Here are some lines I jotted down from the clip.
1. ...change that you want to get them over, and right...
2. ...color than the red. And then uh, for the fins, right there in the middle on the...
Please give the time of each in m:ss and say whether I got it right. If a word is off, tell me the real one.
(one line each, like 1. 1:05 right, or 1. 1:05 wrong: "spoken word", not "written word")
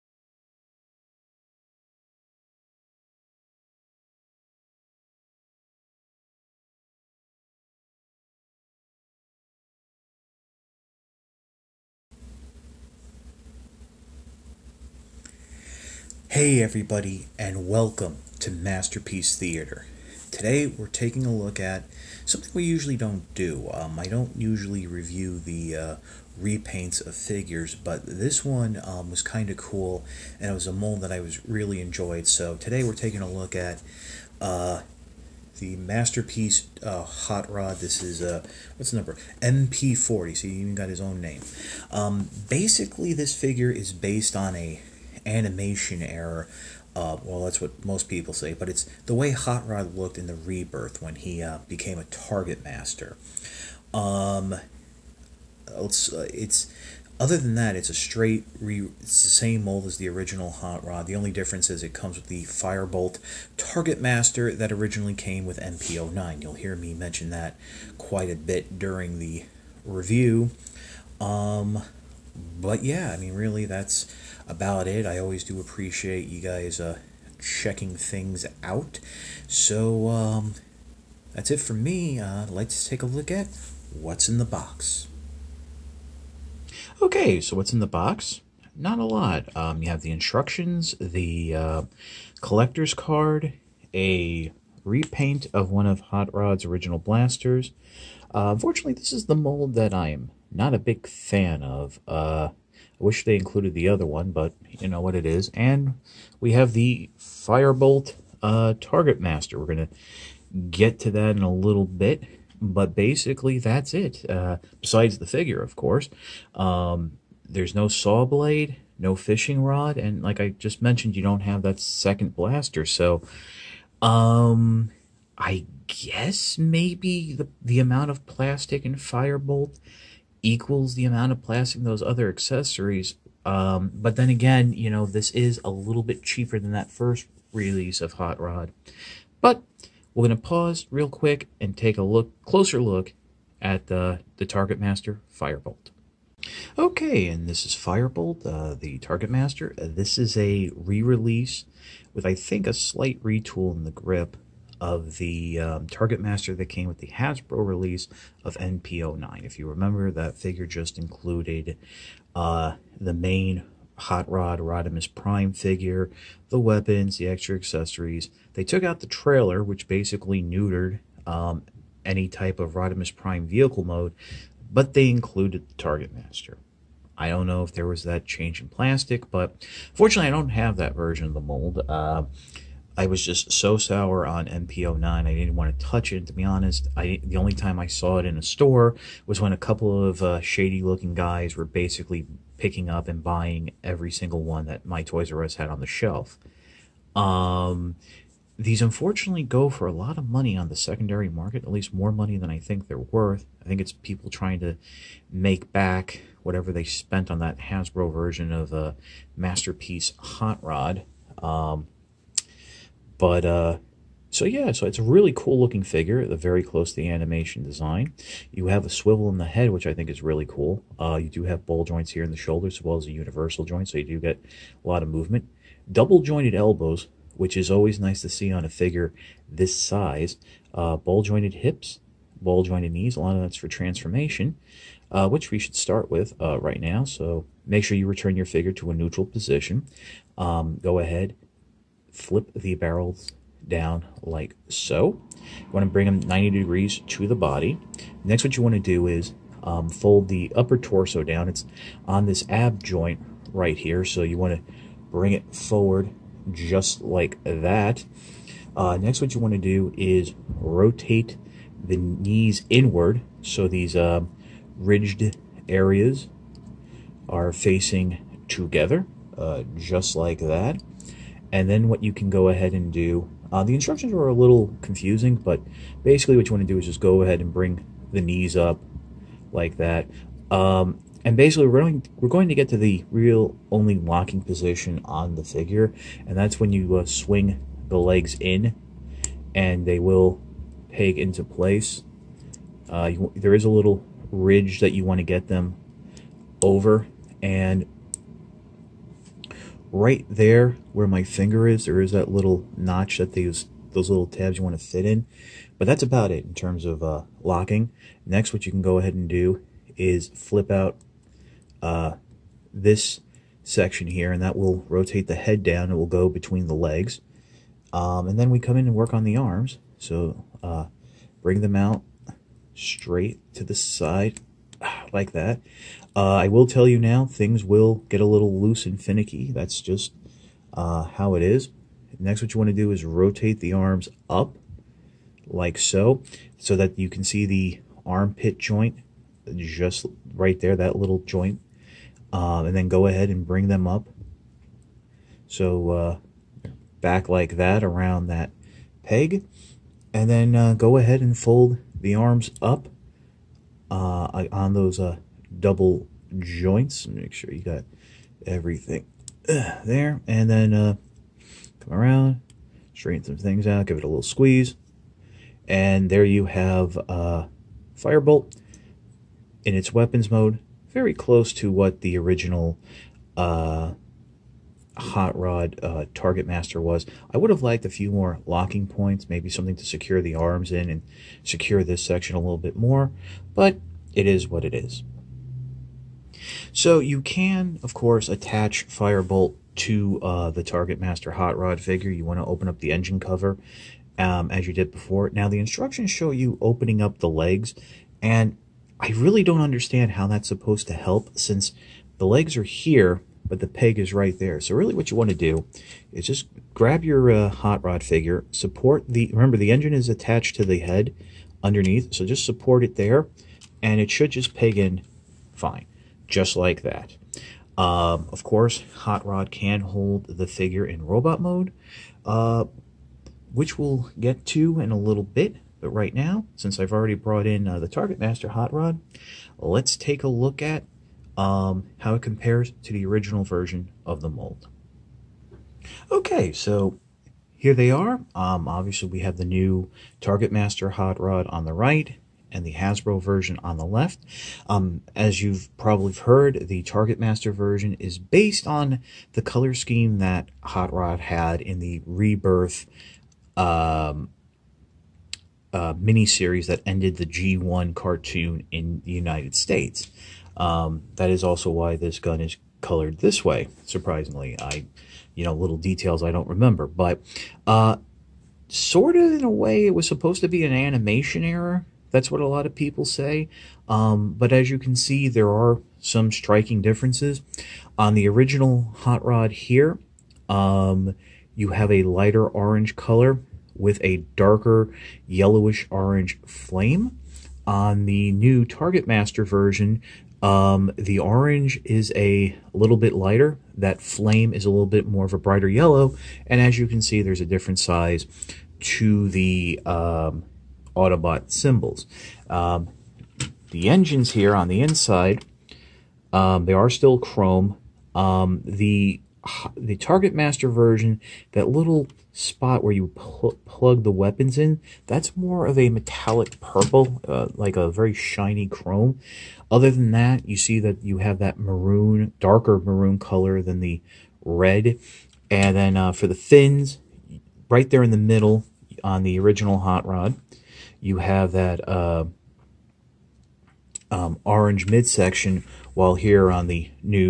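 1. 4:54 wrong: "ridge", not "change"
2. 8:43 right.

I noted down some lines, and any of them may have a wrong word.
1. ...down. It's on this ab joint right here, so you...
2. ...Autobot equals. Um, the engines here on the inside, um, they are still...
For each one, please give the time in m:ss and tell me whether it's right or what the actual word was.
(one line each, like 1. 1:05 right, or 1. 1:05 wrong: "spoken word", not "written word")
1. 4:11 right
2. 8:20 wrong: "symbols", not "equals".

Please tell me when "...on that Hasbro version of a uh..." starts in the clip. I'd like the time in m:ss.
3:27.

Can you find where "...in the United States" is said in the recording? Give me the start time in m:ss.
7:38.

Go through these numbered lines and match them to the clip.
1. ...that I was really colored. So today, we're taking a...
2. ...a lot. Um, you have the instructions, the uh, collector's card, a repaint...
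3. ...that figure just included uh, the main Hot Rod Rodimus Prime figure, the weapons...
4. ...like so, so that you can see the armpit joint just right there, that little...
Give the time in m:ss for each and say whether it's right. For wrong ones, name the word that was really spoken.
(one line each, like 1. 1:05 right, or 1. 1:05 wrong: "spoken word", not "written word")
1. 0:31 wrong: "enjoyed", not "colored"
2. 1:28 right
3. 2:40 right
4. 5:35 right.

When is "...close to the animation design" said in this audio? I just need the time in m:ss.
3:36.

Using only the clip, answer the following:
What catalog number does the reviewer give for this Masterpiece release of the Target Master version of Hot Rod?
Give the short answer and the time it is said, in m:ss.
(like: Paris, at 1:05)
MP40, at 0:39.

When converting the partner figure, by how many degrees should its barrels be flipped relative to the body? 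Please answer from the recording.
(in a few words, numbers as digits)
90.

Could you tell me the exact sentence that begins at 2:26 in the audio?
Okay, and this is Firebolt, uh, the Target Master.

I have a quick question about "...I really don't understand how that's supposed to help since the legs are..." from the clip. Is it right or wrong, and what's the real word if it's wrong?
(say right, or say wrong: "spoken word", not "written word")
right.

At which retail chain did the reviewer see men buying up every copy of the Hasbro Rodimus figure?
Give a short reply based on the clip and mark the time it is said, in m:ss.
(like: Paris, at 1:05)
Toys R Us, at 3:15.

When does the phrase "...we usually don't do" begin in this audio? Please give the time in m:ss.
0:22.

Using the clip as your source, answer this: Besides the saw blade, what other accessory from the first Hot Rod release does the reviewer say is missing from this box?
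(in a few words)
fishing rod.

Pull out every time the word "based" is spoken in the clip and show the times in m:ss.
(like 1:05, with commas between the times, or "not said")
0:43, 7:28.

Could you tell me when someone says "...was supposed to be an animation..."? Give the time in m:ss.
7:49.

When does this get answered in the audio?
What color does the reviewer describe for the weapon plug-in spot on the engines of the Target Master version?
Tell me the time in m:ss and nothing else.
8:35.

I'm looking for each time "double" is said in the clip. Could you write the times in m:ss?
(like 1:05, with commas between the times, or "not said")
3:45, 5:55.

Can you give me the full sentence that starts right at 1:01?
The only difference is it comes with the Firebolt Target Master that originally came with MP09.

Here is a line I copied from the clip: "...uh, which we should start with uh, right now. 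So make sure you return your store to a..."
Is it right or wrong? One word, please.
wrong.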